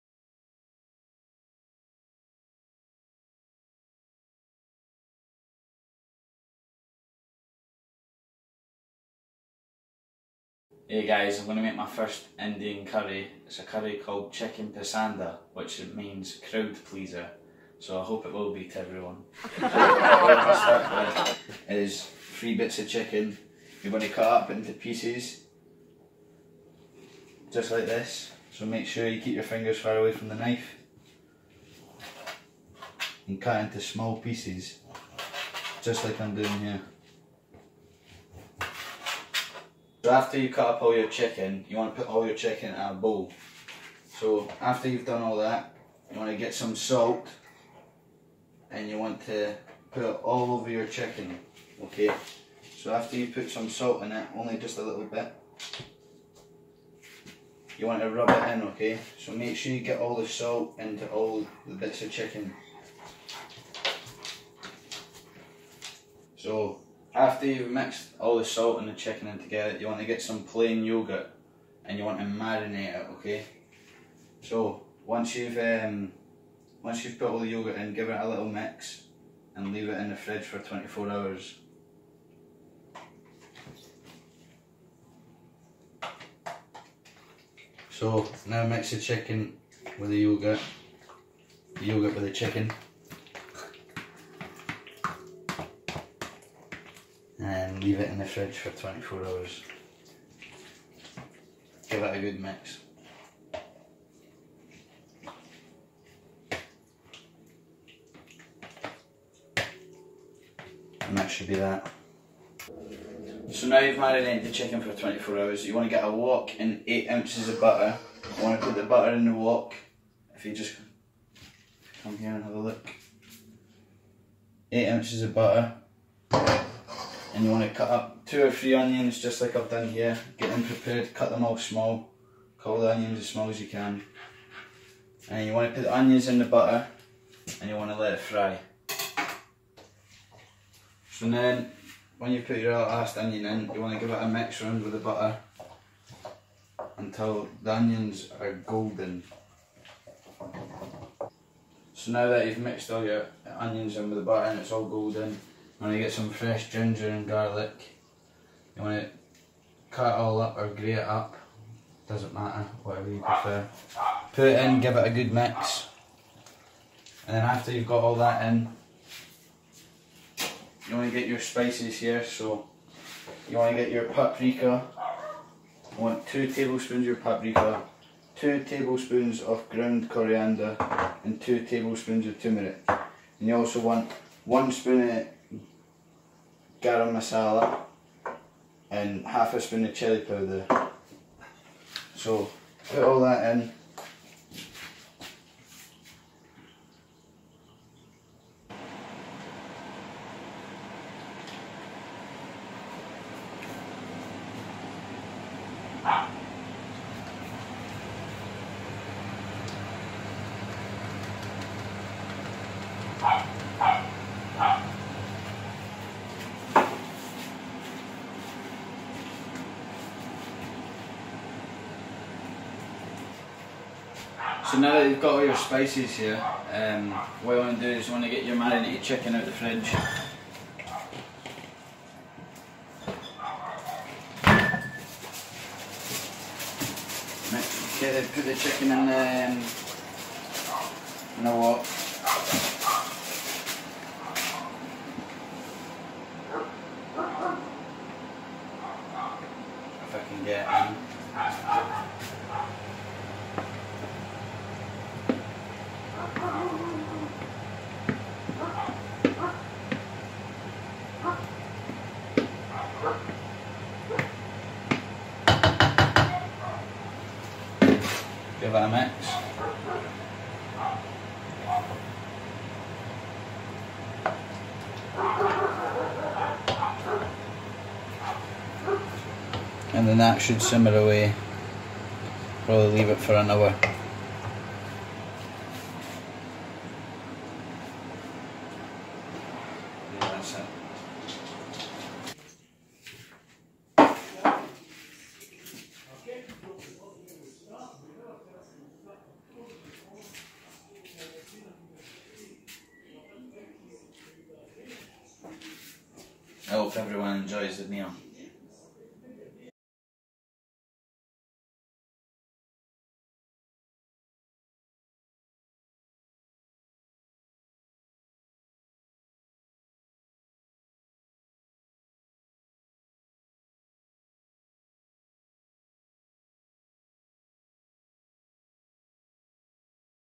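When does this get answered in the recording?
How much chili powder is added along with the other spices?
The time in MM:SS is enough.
03:09.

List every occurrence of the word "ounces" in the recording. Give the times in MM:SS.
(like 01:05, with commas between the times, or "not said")
01:57, 02:04.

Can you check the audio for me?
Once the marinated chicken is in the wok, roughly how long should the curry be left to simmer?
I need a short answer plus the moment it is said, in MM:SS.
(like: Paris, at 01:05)
an hour, at 04:43.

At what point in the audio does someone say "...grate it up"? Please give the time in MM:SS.
02:40.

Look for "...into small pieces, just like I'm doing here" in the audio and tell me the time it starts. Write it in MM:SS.
00:33.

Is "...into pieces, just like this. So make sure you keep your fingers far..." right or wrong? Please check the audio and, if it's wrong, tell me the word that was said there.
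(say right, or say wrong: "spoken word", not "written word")
right.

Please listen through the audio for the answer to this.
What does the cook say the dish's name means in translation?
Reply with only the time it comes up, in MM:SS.
00:16.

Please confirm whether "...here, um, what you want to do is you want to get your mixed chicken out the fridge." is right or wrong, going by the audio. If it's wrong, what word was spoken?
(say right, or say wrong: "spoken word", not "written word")
wrong: "marinated", not "mixed".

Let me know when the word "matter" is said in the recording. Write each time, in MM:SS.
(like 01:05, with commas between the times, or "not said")
02:42.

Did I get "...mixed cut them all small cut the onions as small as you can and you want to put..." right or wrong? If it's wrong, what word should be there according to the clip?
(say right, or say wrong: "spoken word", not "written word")
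wrong: "prepared", not "mixed".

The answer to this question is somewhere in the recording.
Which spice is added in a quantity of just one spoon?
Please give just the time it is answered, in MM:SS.
03:06.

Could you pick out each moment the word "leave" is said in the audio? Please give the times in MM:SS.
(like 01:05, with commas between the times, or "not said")
01:19, 01:37, 04:42.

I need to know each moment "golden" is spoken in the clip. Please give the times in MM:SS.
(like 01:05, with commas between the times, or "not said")
02:28, 02:34.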